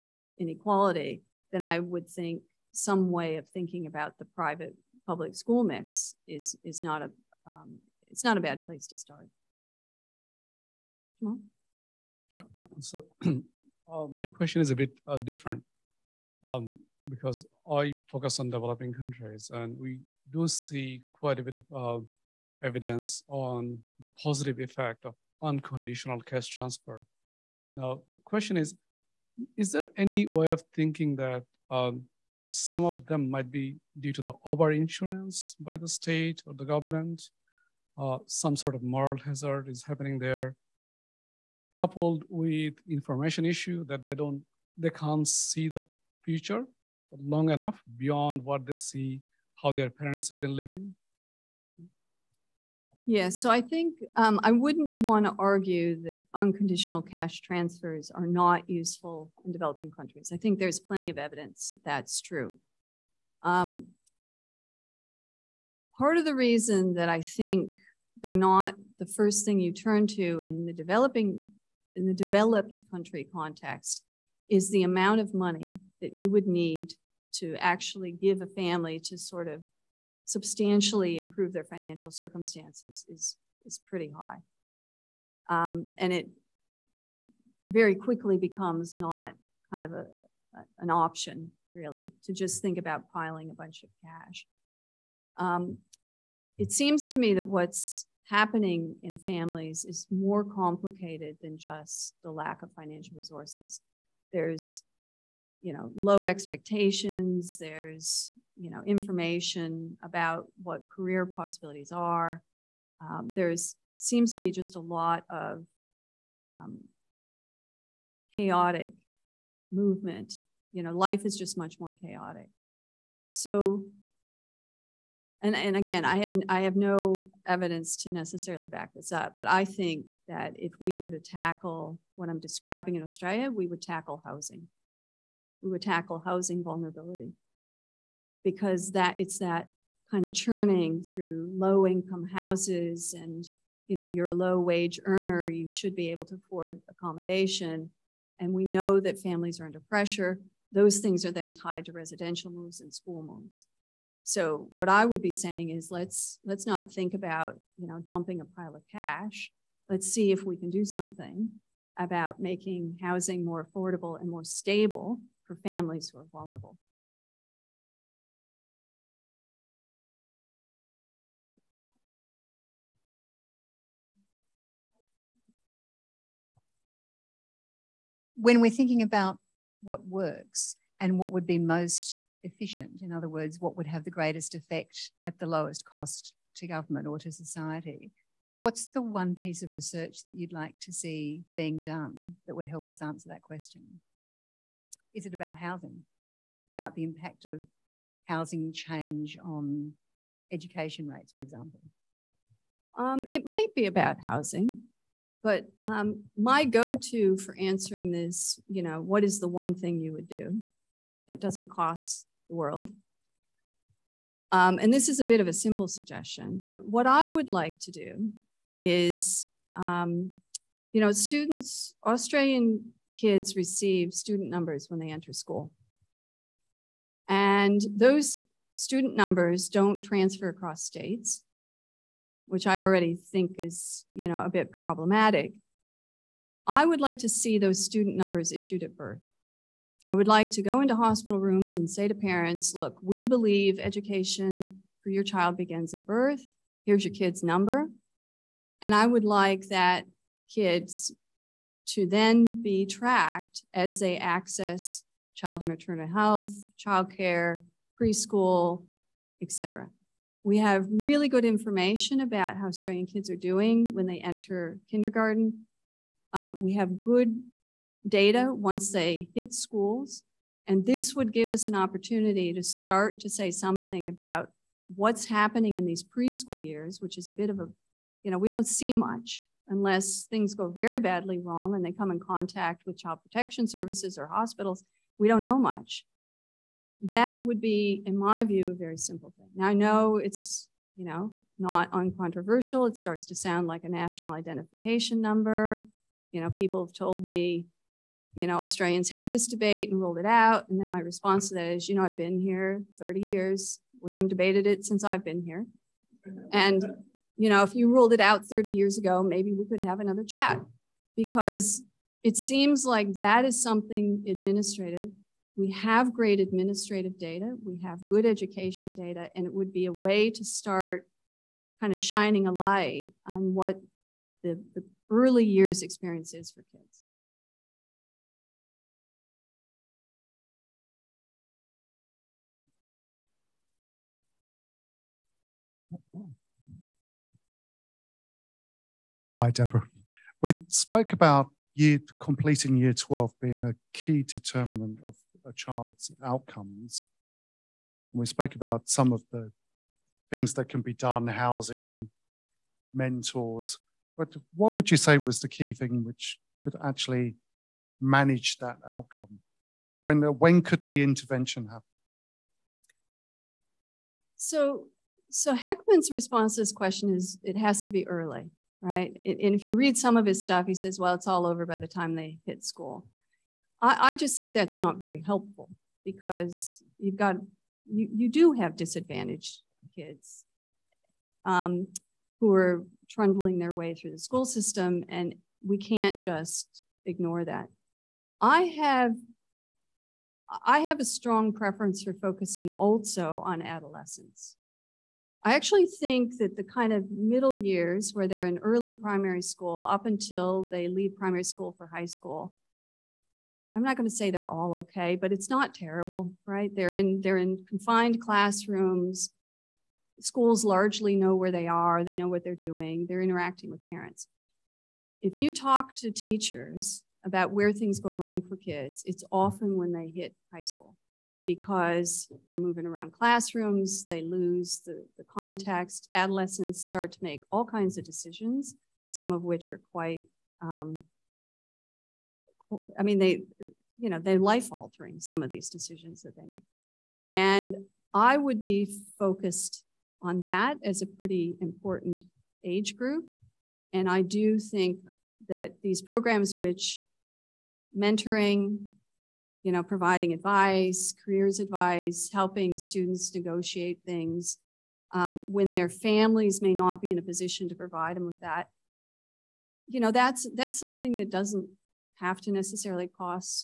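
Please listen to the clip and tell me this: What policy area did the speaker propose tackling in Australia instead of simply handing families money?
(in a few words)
Housing vulnerability.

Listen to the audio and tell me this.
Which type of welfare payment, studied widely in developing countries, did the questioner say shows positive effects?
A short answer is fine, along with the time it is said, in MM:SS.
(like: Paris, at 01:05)
Unconditional cash transfer, at 00:25.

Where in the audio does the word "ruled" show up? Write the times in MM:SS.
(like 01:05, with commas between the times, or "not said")
04:59, 05:07.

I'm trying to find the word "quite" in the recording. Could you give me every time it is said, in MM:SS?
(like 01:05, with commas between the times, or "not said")
00:21, 07:09.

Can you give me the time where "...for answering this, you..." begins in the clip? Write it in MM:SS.
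03:27.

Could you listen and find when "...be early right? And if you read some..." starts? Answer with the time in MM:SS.
06:07.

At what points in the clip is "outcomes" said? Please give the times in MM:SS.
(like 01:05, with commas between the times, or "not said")
05:46, 05:58.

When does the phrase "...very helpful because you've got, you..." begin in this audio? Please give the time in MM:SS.
06:14.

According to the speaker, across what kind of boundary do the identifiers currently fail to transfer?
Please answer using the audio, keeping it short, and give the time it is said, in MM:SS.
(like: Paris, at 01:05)
States, at 03:50.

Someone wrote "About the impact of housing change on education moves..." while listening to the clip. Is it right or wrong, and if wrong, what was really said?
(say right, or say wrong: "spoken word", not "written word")
wrong: "rates", not "moves".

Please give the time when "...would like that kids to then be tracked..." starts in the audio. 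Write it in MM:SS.
04:09.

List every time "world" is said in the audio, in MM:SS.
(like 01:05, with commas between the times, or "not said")
03:32.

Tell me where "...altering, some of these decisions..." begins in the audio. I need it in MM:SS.
07:14.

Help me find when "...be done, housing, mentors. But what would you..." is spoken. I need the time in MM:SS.
05:50.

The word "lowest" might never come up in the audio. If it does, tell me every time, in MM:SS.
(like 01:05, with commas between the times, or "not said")
03:05.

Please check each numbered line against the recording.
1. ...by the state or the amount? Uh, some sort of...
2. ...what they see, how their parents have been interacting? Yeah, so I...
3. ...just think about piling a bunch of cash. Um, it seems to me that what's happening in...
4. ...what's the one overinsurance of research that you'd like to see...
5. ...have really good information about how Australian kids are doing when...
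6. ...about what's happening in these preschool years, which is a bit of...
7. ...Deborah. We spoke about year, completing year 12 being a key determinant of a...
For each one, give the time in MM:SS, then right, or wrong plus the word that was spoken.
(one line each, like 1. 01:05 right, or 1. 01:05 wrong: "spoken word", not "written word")
1. 00:35 wrong: "government", not "amount"
2. 00:48 wrong: "living", not "interacting"
3. 01:32 right
4. 03:08 wrong: "piece", not "overinsurance"
5. 04:20 right
6. 04:34 right
7. 05:39 right.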